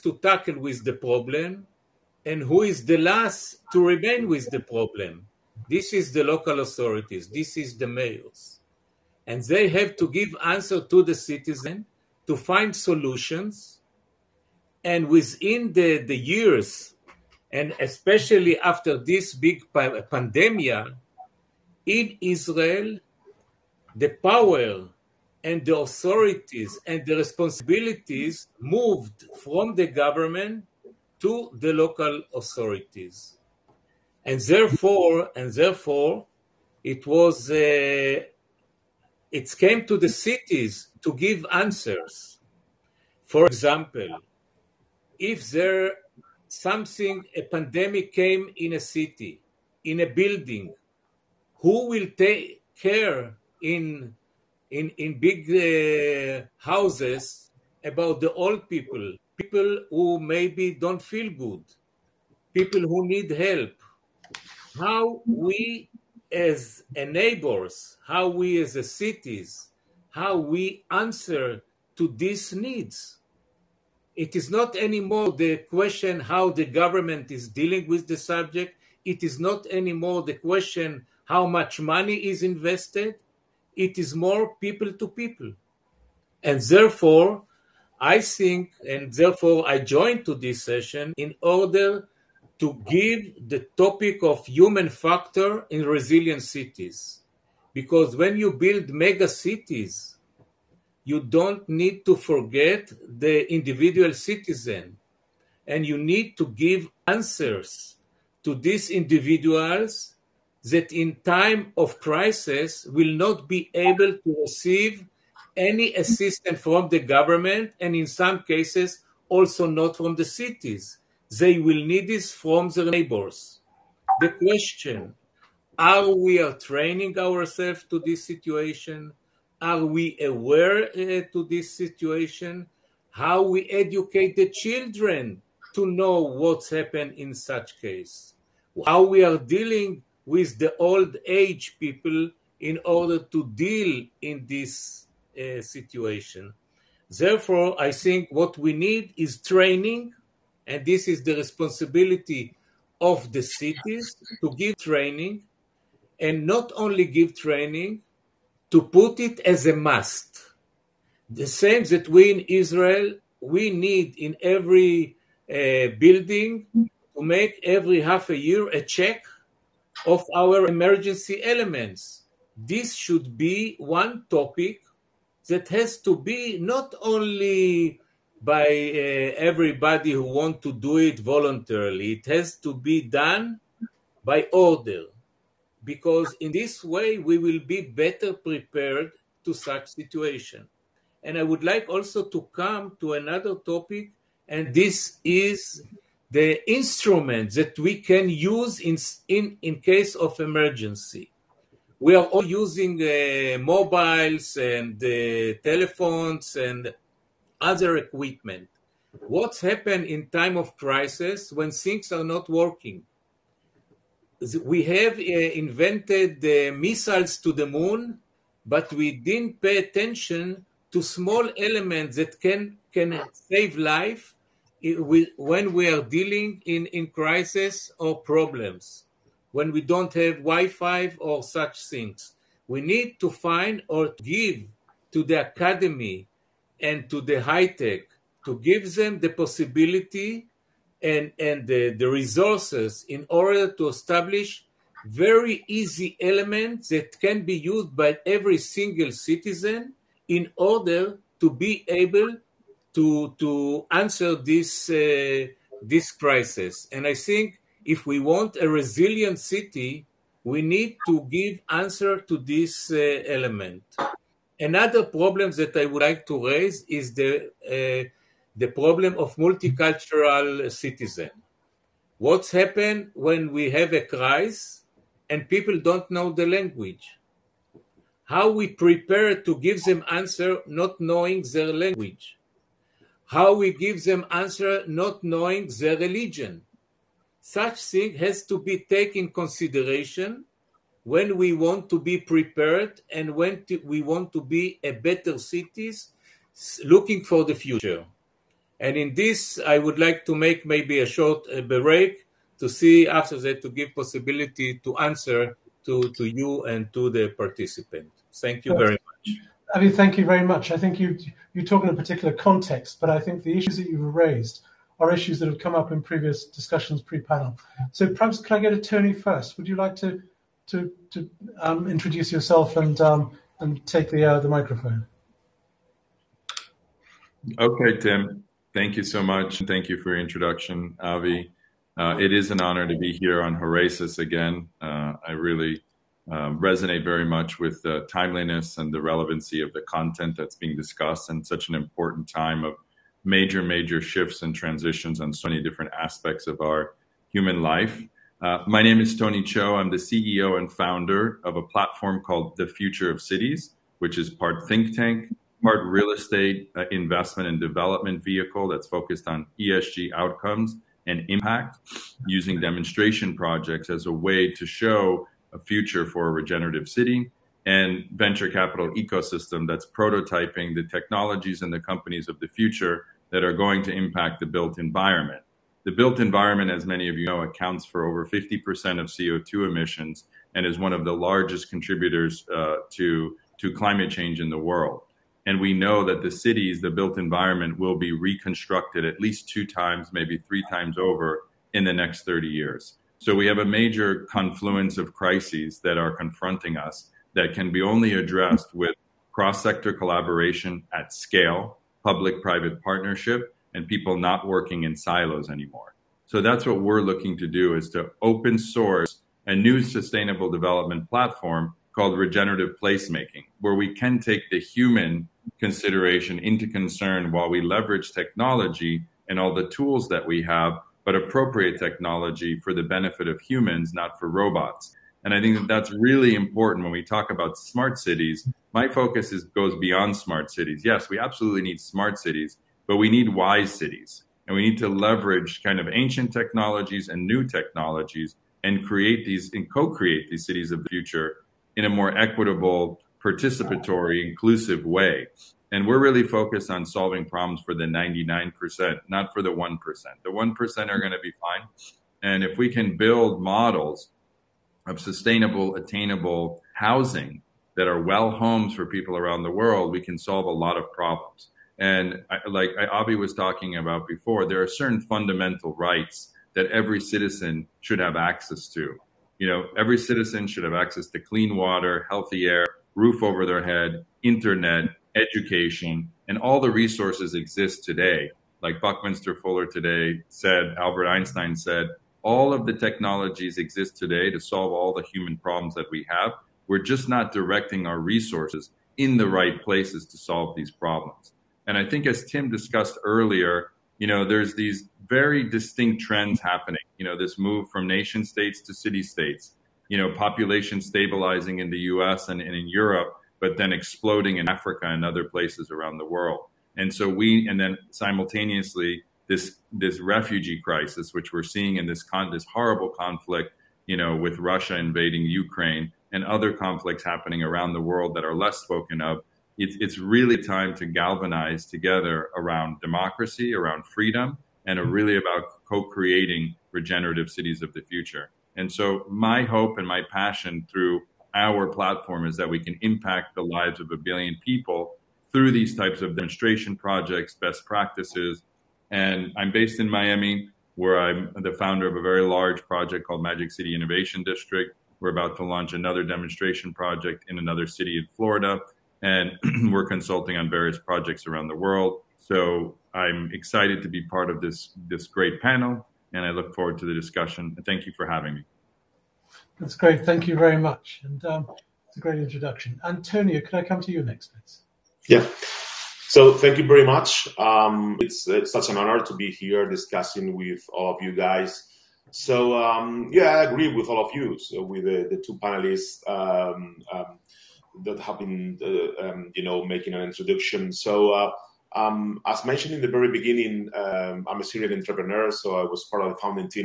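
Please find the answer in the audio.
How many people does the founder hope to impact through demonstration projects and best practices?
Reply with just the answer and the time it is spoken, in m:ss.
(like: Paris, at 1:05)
a billion, at 8:53.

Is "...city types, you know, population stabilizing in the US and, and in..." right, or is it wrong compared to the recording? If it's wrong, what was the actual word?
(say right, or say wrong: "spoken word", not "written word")
wrong: "states", not "types".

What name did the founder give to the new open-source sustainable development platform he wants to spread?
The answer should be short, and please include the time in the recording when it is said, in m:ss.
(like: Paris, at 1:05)
regenerative placemaking, at 6:52.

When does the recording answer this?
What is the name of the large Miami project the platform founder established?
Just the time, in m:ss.
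9:03.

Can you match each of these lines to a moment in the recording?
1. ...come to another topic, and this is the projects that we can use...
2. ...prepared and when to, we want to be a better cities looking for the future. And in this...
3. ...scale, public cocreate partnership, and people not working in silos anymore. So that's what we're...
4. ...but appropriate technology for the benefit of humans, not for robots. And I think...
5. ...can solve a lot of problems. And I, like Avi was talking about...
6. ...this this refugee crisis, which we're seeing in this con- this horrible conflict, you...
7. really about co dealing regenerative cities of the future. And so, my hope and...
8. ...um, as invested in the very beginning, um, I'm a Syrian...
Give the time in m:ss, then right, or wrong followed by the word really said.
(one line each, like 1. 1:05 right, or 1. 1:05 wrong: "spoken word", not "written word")
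1. 3:12 wrong: "instruments", not "projects"
2. 4:52 right
3. 6:41 wrong: "private", not "cocreate"
4. 7:01 right
5. 7:39 right
6. 8:29 right
7. 8:44 wrong: "creating", not "dealing"
8. 9:41 wrong: "mentioned", not "invested".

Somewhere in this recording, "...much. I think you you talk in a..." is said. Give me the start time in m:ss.
5:10.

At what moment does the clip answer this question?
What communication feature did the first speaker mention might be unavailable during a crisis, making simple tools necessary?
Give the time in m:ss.
3:50.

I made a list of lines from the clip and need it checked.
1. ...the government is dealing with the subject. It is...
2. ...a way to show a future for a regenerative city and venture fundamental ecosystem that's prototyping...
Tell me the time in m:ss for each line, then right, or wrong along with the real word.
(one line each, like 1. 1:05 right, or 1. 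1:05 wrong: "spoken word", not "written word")
1. 1:16 right
2. 6:04 wrong: "capital", not "fundamental".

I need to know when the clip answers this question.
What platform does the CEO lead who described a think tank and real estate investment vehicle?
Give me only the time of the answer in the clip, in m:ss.
5:52.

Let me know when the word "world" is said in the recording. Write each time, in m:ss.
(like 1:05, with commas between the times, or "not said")
6:24, 7:39, 8:26, 8:37, 9:11.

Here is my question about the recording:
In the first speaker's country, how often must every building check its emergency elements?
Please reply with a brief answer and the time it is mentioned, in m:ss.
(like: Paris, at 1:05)
every half a year, at 2:47.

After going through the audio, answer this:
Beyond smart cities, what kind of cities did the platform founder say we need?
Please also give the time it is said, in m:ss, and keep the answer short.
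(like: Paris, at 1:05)
wise cities, at 7:13.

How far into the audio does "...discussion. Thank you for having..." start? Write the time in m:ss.
9:16.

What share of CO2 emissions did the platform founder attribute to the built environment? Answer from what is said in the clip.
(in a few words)
over 50%.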